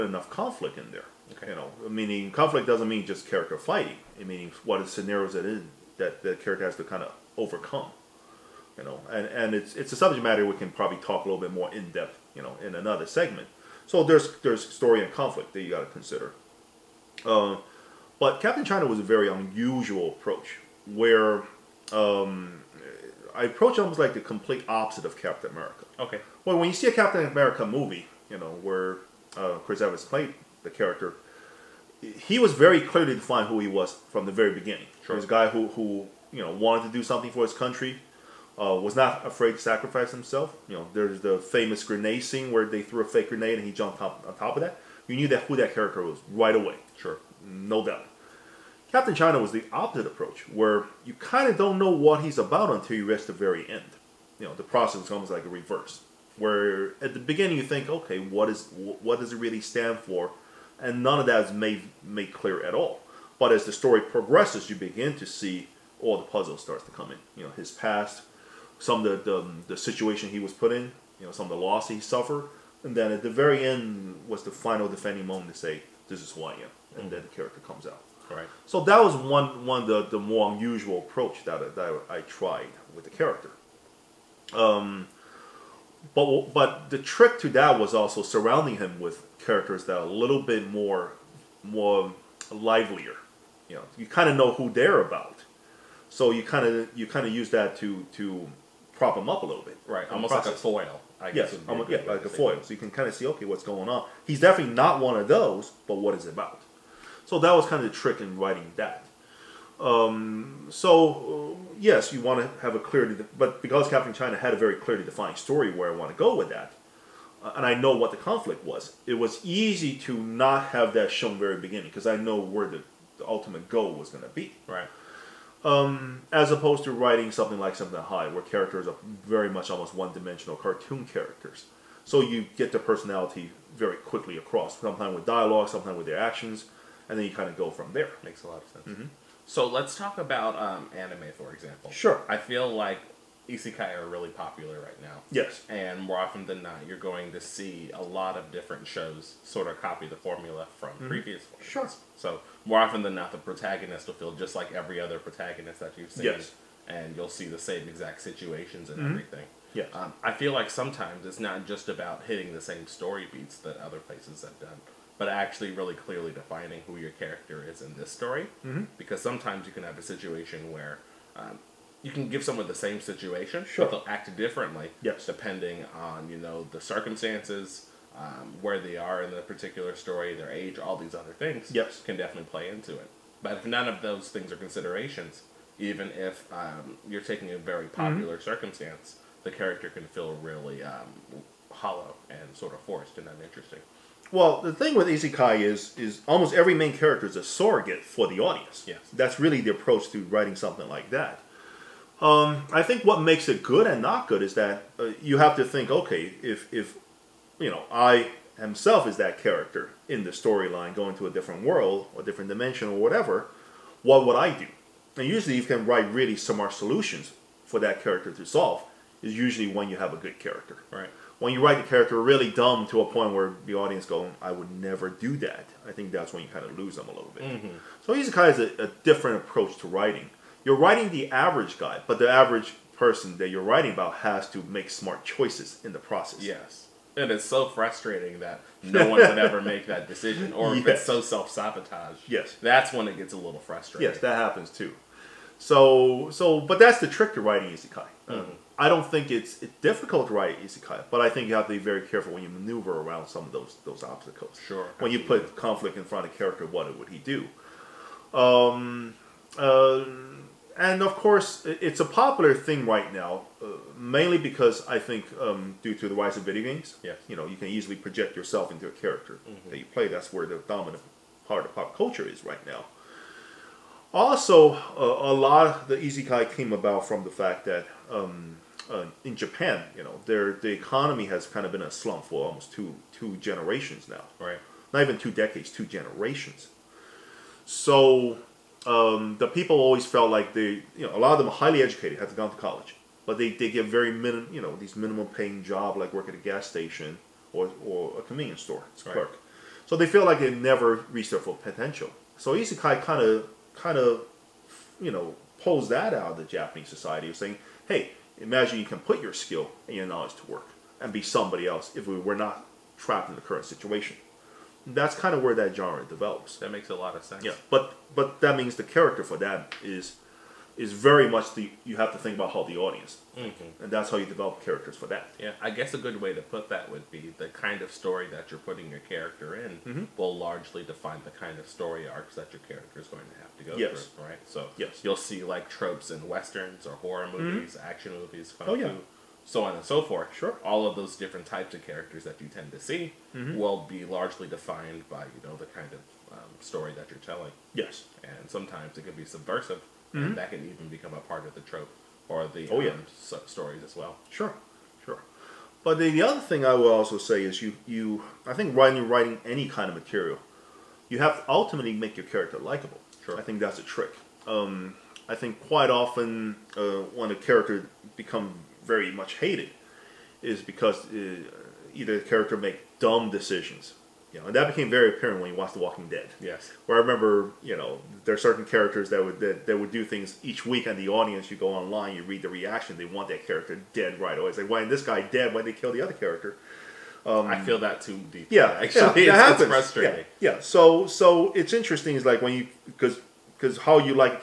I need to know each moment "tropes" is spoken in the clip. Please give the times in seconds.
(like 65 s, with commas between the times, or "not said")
335 s, 351 s.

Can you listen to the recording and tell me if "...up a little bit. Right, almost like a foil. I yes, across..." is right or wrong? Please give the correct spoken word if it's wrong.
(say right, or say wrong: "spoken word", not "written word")
wrong: "guess", not "across".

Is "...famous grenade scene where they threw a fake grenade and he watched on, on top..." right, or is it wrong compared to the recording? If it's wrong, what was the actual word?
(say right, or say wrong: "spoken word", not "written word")
wrong: "jumped", not "watched".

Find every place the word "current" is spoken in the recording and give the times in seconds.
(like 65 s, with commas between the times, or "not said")
313 s.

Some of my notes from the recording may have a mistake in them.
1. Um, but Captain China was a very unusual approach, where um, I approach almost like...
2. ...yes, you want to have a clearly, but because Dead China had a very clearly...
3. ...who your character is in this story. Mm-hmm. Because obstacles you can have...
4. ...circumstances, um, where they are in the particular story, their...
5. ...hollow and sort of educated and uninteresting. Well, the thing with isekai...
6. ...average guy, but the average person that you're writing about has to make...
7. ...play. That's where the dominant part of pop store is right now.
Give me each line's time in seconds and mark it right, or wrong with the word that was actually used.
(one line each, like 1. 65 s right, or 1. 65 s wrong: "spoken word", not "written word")
1. 17 s right
2. 111 s wrong: "Captain", not "Dead"
3. 166 s wrong: "sometimes", not "obstacles"
4. 176 s right
5. 191 s wrong: "forced", not "educated"
6. 231 s right
7. 269 s wrong: "culture", not "store".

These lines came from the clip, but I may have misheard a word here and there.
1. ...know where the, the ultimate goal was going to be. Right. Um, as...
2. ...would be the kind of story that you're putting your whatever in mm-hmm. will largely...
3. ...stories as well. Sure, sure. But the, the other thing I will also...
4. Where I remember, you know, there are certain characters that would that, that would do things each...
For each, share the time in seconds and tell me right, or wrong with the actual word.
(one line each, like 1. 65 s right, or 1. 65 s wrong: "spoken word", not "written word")
1. 122 s right
2. 326 s wrong: "character", not "whatever"
3. 353 s right
4. 376 s right.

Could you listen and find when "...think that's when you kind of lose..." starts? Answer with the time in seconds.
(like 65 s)
225 s.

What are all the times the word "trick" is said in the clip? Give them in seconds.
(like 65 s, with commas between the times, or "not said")
86 s, 107 s, 247 s, 363 s.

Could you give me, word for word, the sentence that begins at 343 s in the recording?
will be largely defined by you know the kind of um, story that you're telling.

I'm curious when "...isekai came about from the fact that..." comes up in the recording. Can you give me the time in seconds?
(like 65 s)
276 s.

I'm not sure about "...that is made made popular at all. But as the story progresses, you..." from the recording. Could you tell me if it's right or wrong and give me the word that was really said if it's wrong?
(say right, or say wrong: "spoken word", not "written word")
wrong: "clear", not "popular".